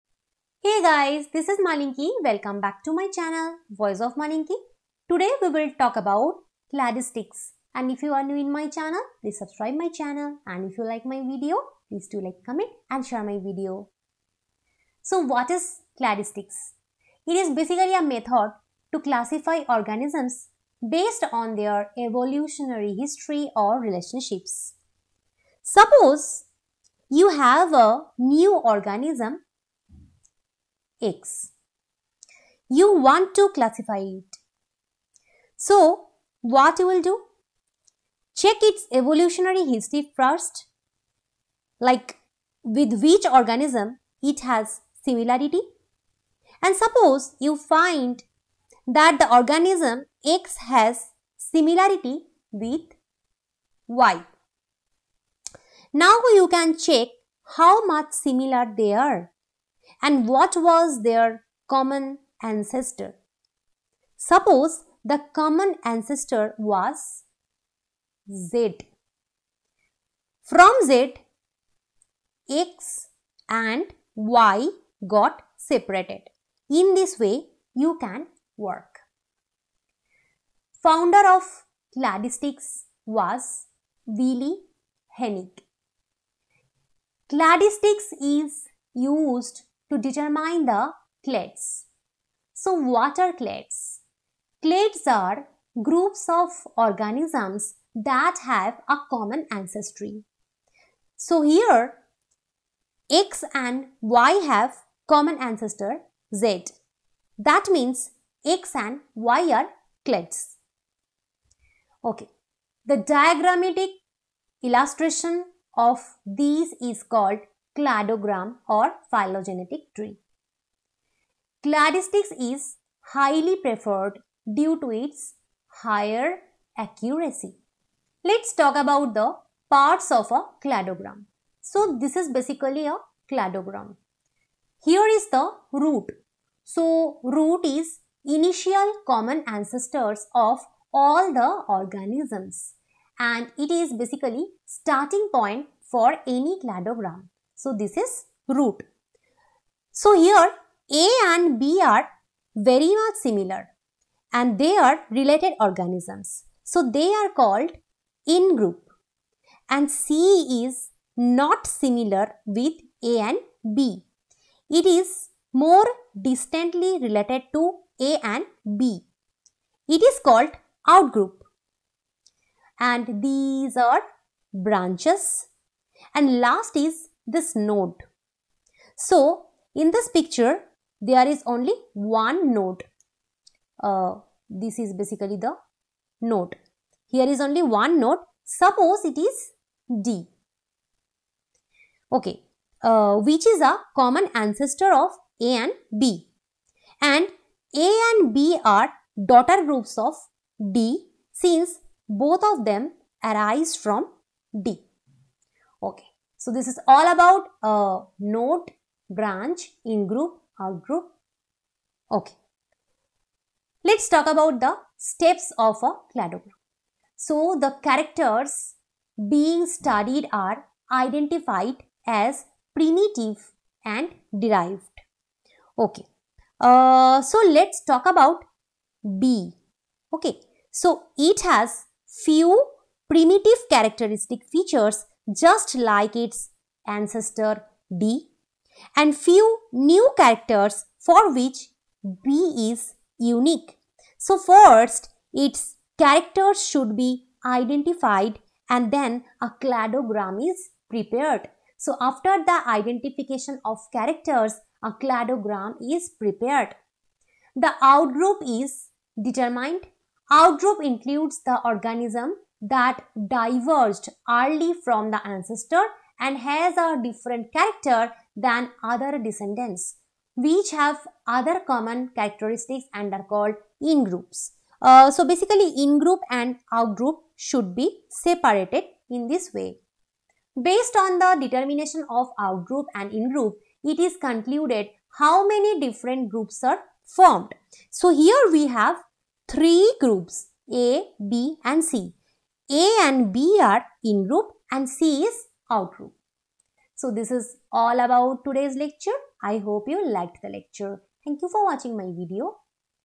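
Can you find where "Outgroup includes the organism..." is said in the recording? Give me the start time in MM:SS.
04:20.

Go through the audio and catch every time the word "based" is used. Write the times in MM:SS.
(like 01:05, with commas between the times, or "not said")
00:20, 04:40.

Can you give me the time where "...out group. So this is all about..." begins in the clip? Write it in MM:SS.
04:55.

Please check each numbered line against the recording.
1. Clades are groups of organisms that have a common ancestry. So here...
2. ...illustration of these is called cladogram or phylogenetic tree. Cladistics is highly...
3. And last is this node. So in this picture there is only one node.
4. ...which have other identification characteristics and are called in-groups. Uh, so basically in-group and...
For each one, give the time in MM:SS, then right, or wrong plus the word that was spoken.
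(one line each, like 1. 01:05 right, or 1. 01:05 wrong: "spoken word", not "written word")
1. 01:34 right
2. 01:54 right
3. 02:56 right
4. 04:30 wrong: "common", not "identification".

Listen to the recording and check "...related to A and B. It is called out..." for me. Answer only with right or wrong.
right.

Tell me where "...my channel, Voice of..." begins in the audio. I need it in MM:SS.
00:02.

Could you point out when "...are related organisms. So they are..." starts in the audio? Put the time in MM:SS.
02:34.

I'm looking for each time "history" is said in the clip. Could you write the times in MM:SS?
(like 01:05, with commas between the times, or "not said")
00:22, 00:39.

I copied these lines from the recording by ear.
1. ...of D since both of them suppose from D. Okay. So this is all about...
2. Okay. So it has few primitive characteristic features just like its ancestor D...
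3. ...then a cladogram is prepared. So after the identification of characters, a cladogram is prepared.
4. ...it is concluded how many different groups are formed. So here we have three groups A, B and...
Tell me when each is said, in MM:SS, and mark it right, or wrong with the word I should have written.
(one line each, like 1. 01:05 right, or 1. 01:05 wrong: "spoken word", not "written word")
1. 03:19 wrong: "arise", not "suppose"
2. 03:50 right
3. 04:08 right
4. 04:43 right.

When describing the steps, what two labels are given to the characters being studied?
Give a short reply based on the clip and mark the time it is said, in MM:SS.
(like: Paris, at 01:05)
primitive and derived, at 03:42.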